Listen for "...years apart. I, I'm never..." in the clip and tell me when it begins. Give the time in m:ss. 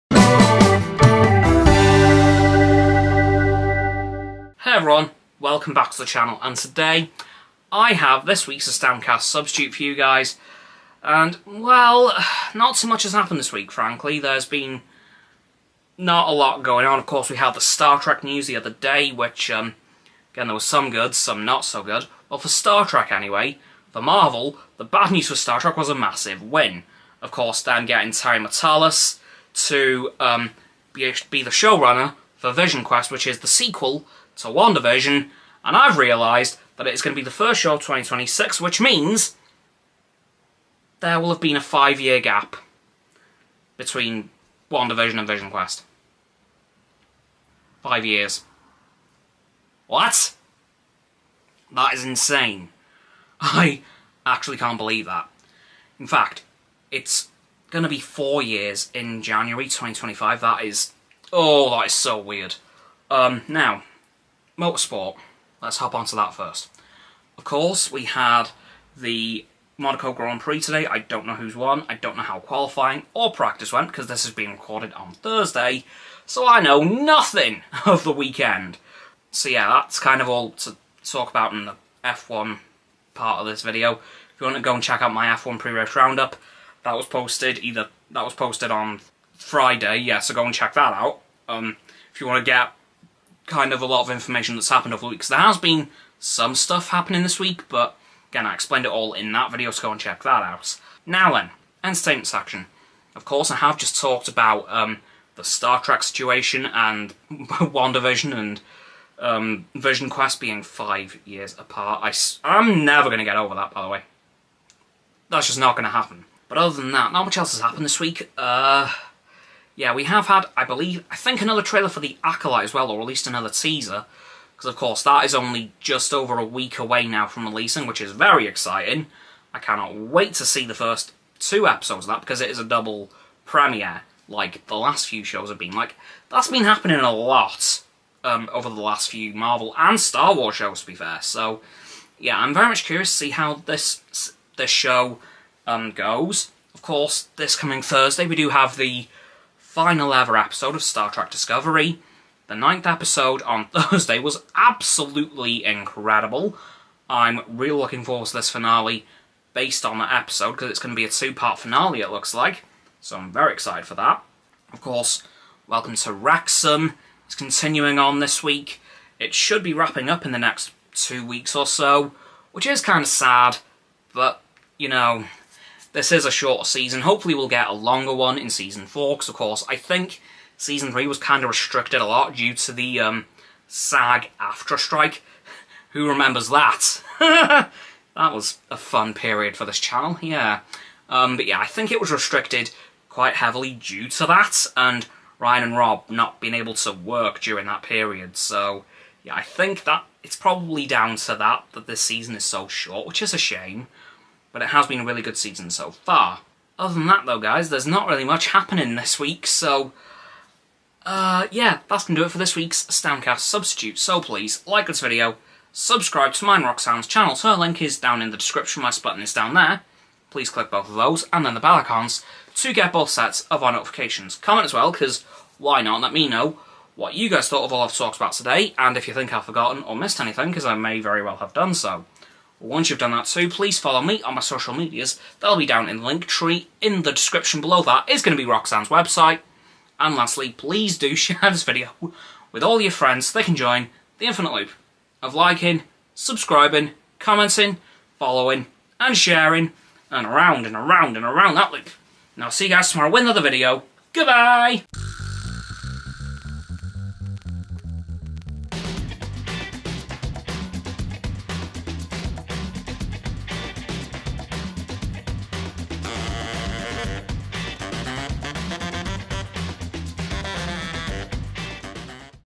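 1:51.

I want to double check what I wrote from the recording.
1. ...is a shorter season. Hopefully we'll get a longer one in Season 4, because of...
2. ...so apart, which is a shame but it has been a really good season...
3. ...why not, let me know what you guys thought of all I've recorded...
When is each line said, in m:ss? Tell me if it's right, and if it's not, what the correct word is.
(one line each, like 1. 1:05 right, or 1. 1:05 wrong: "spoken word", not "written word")
1. 2:56 right
2. 3:22 wrong: "short", not "apart"
3. 3:45 wrong: "talked", not "recorded".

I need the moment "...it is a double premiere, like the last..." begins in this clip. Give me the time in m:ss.
2:12.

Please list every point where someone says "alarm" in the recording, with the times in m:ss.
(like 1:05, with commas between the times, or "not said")
not said.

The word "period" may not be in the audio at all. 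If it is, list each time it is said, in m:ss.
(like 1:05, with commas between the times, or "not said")
3:09, 3:17.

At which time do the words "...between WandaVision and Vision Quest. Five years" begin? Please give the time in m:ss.
0:43.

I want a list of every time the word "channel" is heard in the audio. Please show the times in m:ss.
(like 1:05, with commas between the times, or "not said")
0:06, 3:09, 3:37.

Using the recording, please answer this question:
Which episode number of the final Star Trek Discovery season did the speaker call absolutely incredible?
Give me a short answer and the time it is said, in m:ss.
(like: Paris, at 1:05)
9, at 2:32.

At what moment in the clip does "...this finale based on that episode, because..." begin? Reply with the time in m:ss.
2:38.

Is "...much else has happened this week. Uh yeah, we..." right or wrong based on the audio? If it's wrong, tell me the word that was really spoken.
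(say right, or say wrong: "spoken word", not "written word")
right.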